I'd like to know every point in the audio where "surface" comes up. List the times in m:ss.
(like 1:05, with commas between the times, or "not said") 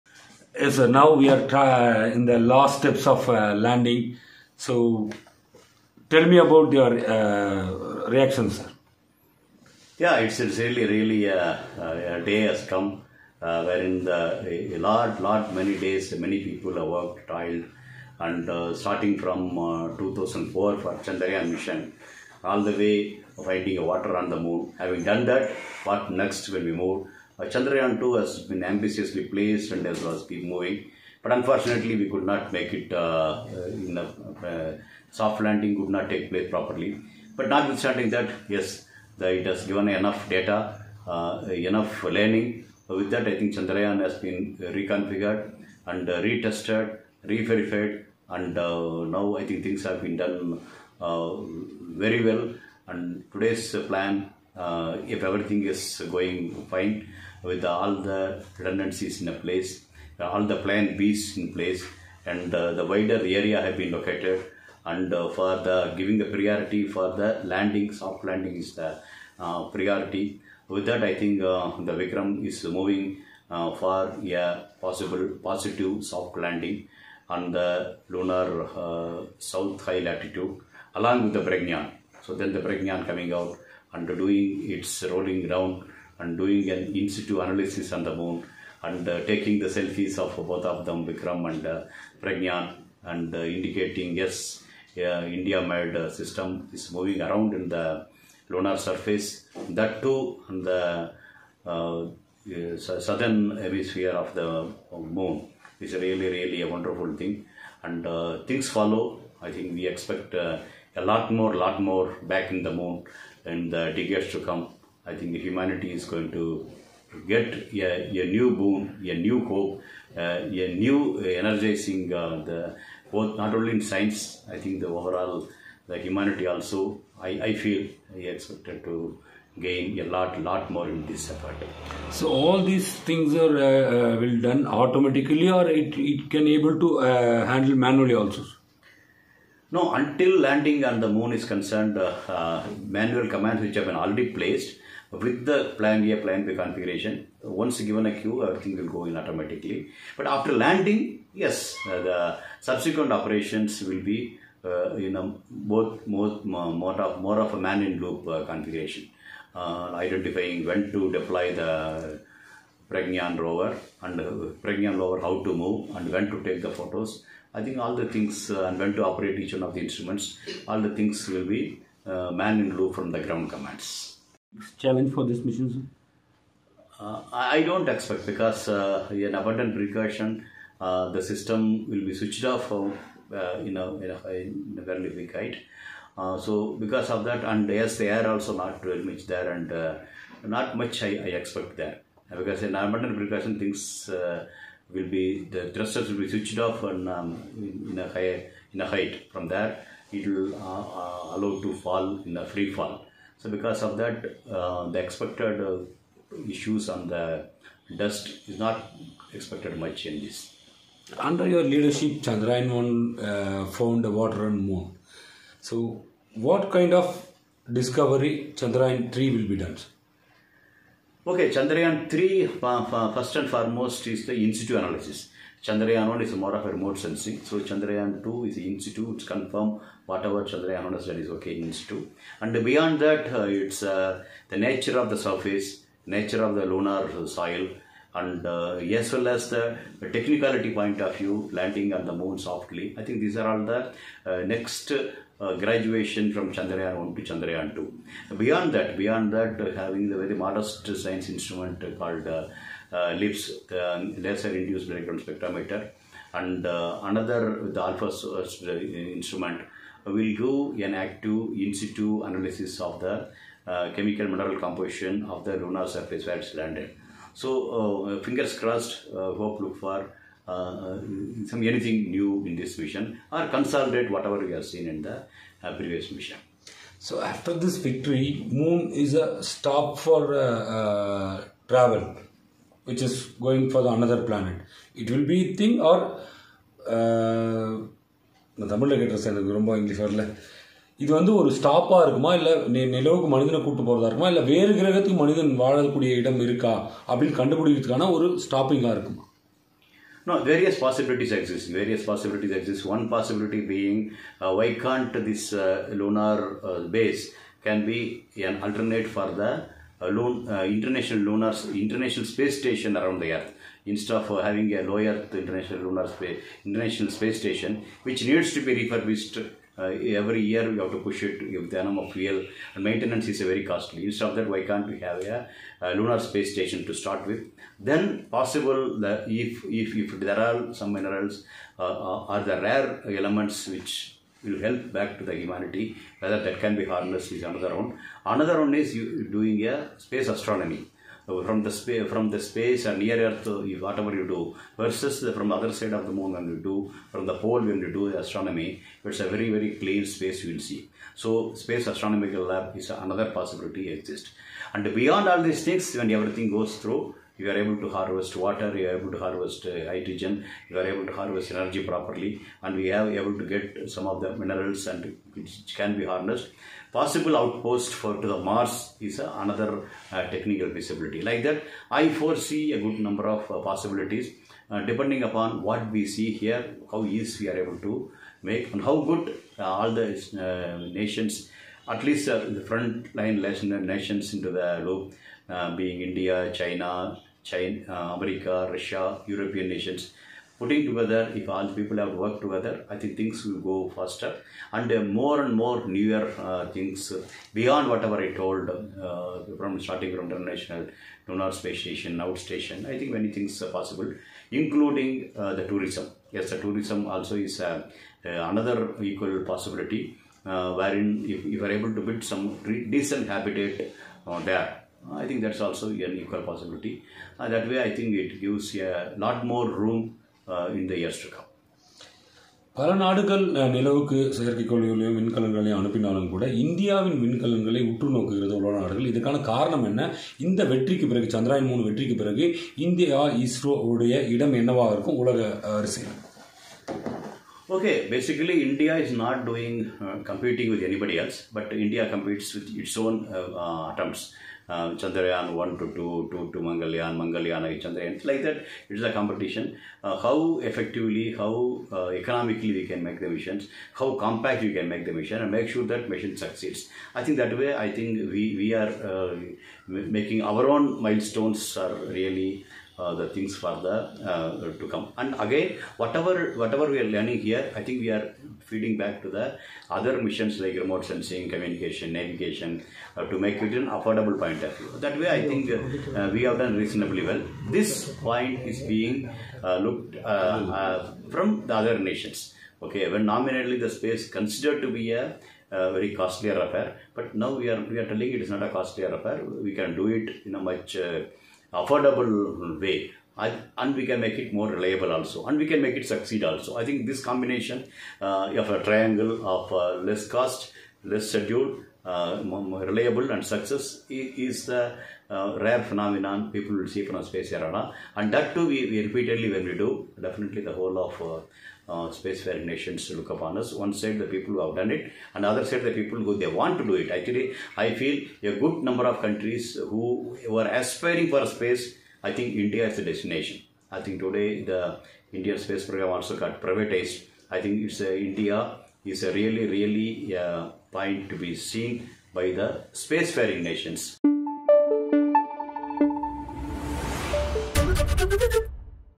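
1:38, 3:55, 4:25.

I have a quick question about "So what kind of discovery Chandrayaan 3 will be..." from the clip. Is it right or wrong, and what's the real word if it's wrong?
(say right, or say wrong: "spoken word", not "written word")
right.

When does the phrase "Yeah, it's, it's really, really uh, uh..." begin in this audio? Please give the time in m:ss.
0:09.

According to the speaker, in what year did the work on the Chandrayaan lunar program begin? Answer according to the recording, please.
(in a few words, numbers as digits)
2004.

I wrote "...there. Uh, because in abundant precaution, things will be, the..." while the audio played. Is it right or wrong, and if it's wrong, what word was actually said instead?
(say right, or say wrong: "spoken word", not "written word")
right.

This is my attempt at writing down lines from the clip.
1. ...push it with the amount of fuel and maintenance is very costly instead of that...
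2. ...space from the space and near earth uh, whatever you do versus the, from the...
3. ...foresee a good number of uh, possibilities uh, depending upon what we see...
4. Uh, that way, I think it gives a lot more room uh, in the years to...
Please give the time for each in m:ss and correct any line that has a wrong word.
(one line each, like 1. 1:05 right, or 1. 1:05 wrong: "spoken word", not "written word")
1. 5:21 right
2. 5:41 right
3. 6:12 right
4. 6:57 right.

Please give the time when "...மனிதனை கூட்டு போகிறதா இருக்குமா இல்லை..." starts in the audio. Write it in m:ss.
4:53.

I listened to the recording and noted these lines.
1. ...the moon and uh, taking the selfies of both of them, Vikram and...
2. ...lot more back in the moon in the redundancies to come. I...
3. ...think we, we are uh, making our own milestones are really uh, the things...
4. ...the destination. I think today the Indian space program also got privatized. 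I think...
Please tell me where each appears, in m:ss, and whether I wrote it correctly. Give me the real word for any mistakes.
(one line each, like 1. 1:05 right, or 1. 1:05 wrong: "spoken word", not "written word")
1. 1:28 right
2. 1:51 wrong: "decades", not "redundancies"
3. 7:37 right
4. 8:42 right.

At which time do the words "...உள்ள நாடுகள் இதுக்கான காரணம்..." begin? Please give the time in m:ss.
7:08.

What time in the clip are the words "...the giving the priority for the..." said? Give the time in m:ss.
1:05.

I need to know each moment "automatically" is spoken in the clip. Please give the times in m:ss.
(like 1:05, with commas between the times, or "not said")
2:14, 2:29.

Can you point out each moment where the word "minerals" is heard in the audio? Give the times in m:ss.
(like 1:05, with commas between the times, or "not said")
4:24, 5:30, 6:04.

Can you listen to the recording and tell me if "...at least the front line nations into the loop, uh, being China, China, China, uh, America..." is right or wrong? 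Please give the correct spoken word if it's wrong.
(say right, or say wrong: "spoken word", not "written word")
wrong: "India", not "China".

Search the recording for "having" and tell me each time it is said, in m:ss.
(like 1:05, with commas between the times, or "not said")
0:24, 4:09, 5:14.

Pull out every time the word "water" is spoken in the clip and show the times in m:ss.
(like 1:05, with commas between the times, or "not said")
0:23, 3:34, 5:58.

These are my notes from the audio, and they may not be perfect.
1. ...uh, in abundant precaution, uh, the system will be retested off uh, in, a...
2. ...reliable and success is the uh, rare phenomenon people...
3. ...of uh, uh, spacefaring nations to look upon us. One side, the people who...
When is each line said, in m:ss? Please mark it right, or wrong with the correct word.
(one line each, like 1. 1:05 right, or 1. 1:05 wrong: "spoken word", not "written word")
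1. 2:58 wrong: "switched", not "retested"
2. 8:22 right
3. 8:31 right.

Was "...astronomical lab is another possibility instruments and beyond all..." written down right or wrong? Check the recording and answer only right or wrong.
wrong.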